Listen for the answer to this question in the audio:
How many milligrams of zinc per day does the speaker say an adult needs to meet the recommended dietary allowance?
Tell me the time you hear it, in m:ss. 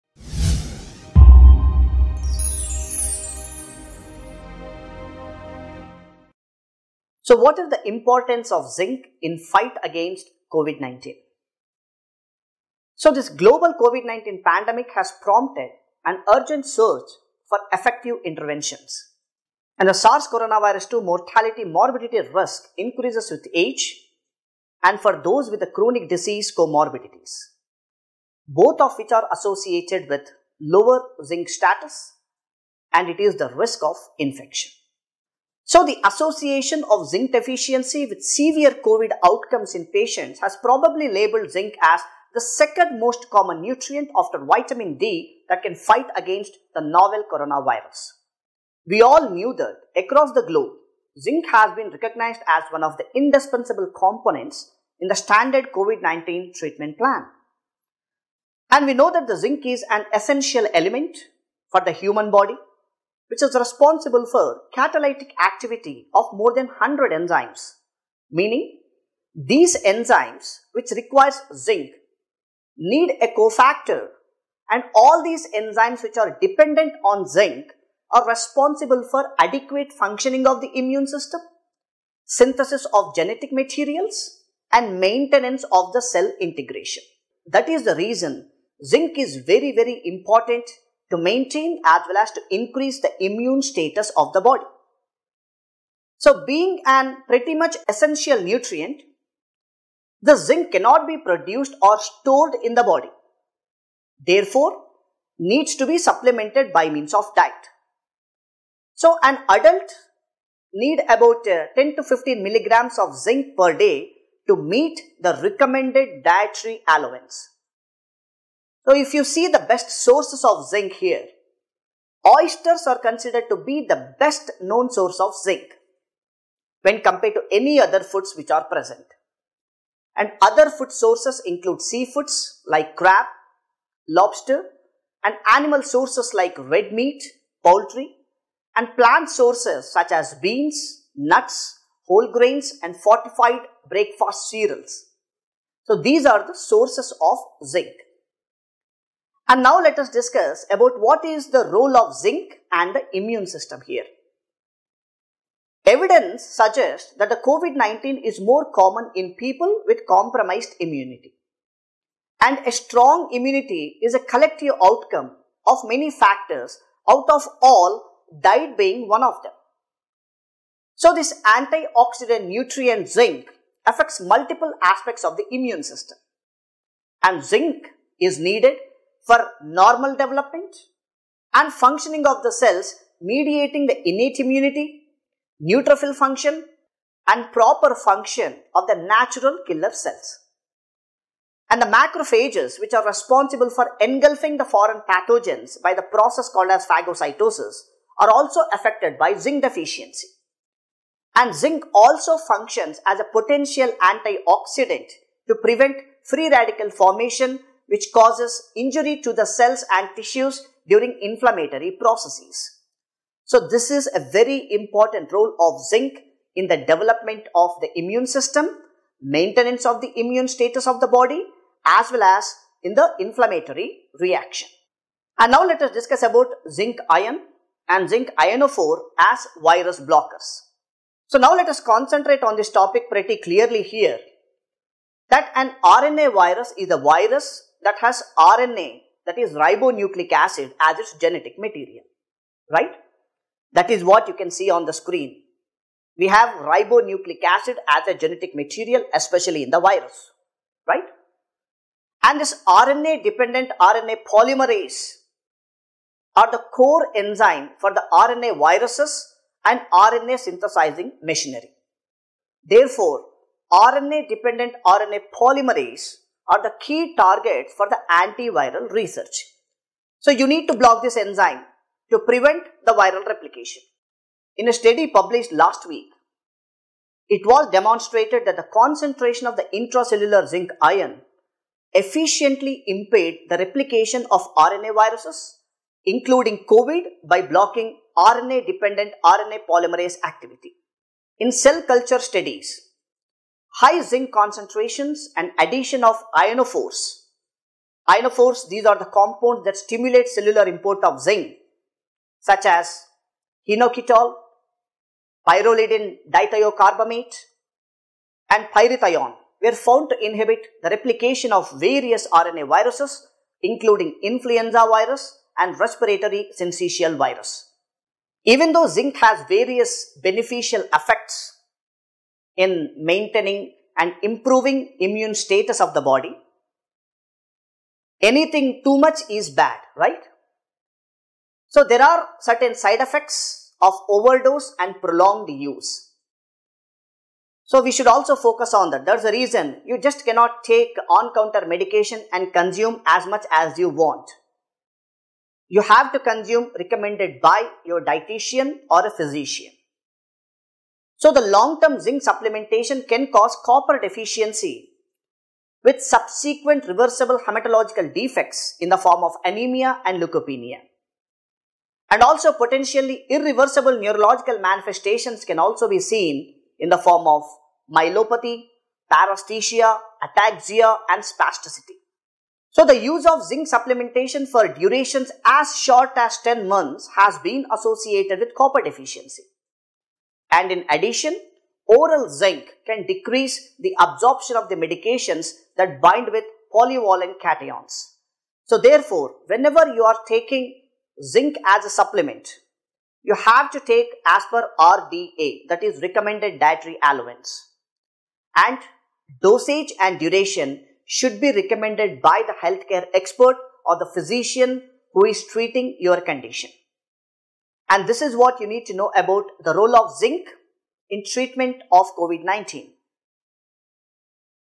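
1:51.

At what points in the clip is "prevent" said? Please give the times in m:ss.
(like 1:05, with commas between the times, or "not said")
3:25, 4:32.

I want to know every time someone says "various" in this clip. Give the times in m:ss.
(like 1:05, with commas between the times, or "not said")
5:11, 5:19.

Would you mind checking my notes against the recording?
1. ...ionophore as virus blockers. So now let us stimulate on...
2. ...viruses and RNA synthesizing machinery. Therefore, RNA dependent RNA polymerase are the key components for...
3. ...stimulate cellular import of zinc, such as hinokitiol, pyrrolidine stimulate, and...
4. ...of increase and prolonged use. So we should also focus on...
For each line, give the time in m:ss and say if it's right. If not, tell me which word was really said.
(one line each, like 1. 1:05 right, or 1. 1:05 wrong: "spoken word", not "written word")
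1. 3:48 wrong: "concentrate", not "stimulate"
2. 4:18 wrong: "targets", not "components"
3. 4:59 wrong: "dithiocarbamate", not "stimulate"
4. 5:33 wrong: "overdose", not "increase".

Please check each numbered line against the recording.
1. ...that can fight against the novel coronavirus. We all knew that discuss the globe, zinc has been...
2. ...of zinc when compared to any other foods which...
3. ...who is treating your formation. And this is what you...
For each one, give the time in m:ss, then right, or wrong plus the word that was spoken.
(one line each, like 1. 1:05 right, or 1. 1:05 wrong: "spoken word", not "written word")
1. 0:45 wrong: "across", not "discuss"
2. 2:05 right
3. 6:45 wrong: "condition", not "formation".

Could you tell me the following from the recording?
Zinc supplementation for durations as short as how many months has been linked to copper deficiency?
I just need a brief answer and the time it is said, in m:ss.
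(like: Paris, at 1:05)
10 months, at 6:16.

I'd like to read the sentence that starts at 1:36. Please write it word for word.
So being an pretty much essential nutrient, the zinc cannot be produced or stored in the body.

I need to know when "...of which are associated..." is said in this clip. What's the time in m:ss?
0:28.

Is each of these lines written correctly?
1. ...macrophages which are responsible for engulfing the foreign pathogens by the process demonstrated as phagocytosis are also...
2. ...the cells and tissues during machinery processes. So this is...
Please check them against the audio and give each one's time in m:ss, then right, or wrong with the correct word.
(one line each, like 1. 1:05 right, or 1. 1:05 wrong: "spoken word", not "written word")
1. 3:11 wrong: "called", not "demonstrated"
2. 3:29 wrong: "inflammatory", not "machinery".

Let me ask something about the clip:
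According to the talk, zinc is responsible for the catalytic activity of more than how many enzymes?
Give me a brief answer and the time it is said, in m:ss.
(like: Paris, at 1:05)
100, at 1:06.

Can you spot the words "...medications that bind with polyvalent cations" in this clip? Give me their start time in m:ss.
6:24.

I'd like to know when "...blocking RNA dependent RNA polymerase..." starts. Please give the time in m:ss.
4:47.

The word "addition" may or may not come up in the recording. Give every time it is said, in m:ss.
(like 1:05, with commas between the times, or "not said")
4:55, 6:20.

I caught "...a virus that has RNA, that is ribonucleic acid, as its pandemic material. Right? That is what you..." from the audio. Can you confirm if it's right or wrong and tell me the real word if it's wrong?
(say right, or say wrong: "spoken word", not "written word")
wrong: "genetic", not "pandemic".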